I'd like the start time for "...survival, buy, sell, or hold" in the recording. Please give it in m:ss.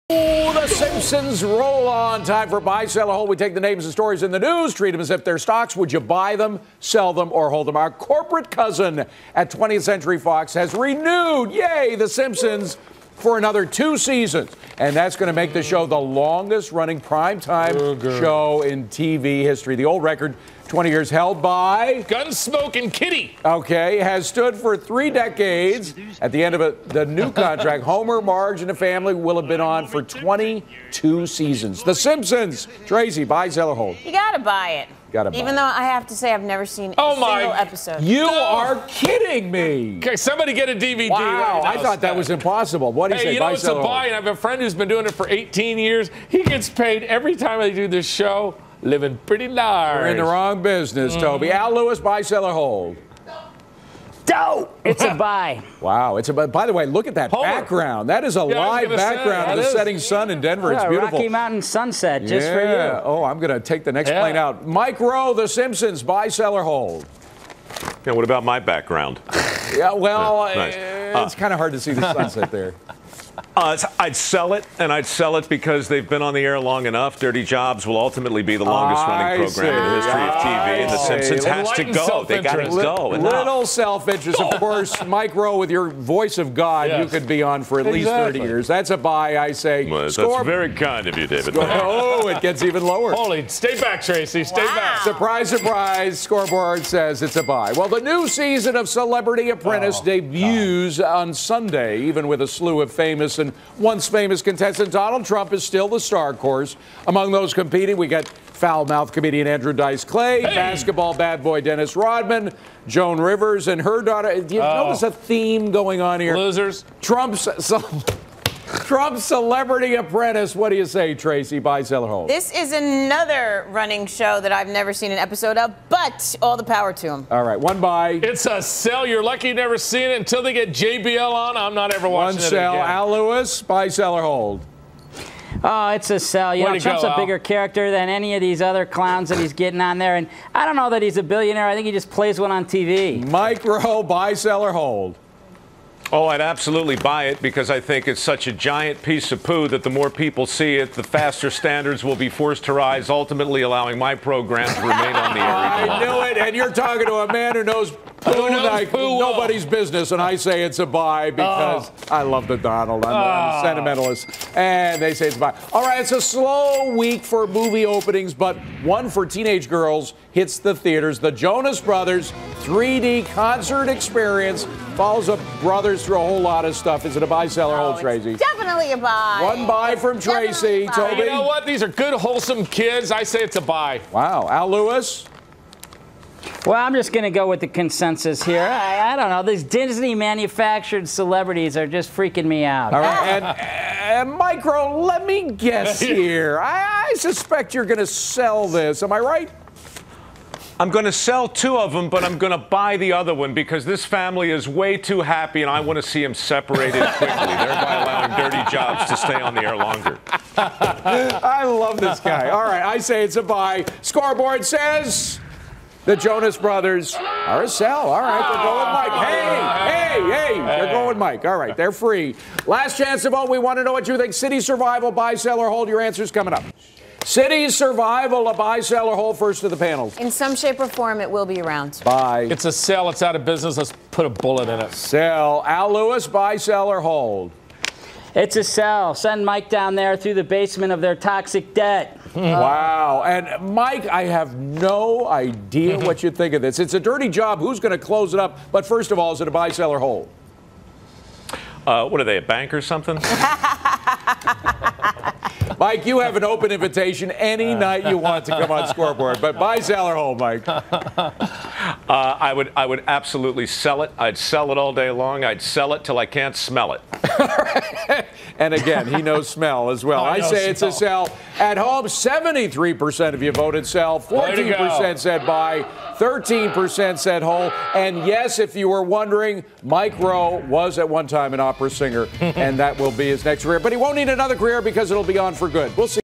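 3:44.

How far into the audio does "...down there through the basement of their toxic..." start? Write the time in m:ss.
3:59.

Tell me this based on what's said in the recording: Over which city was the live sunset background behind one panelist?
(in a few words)
Denver.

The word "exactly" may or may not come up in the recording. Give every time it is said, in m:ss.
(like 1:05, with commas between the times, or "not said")
1:27.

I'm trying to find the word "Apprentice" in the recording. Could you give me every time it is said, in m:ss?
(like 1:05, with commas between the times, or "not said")
1:39, 1:59.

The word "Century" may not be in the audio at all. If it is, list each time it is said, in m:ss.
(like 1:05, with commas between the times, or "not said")
0:09.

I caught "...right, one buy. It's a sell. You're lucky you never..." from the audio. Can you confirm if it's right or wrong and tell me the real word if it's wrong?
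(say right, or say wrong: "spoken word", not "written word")
right.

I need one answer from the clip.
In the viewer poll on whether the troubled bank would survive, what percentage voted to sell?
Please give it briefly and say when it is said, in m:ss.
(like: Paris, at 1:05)
73%, at 4:32.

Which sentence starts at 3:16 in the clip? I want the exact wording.
I, I suspect you're going to sell this.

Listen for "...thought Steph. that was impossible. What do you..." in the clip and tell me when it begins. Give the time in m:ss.
0:41.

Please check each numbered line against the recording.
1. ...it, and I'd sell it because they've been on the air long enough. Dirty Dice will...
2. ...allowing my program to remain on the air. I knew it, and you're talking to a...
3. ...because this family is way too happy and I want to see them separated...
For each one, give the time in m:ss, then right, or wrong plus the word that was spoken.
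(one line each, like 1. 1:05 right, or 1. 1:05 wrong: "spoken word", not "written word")
1. 1:14 wrong: "Jobs", not "Dice"
2. 2:33 right
3. 3:23 right.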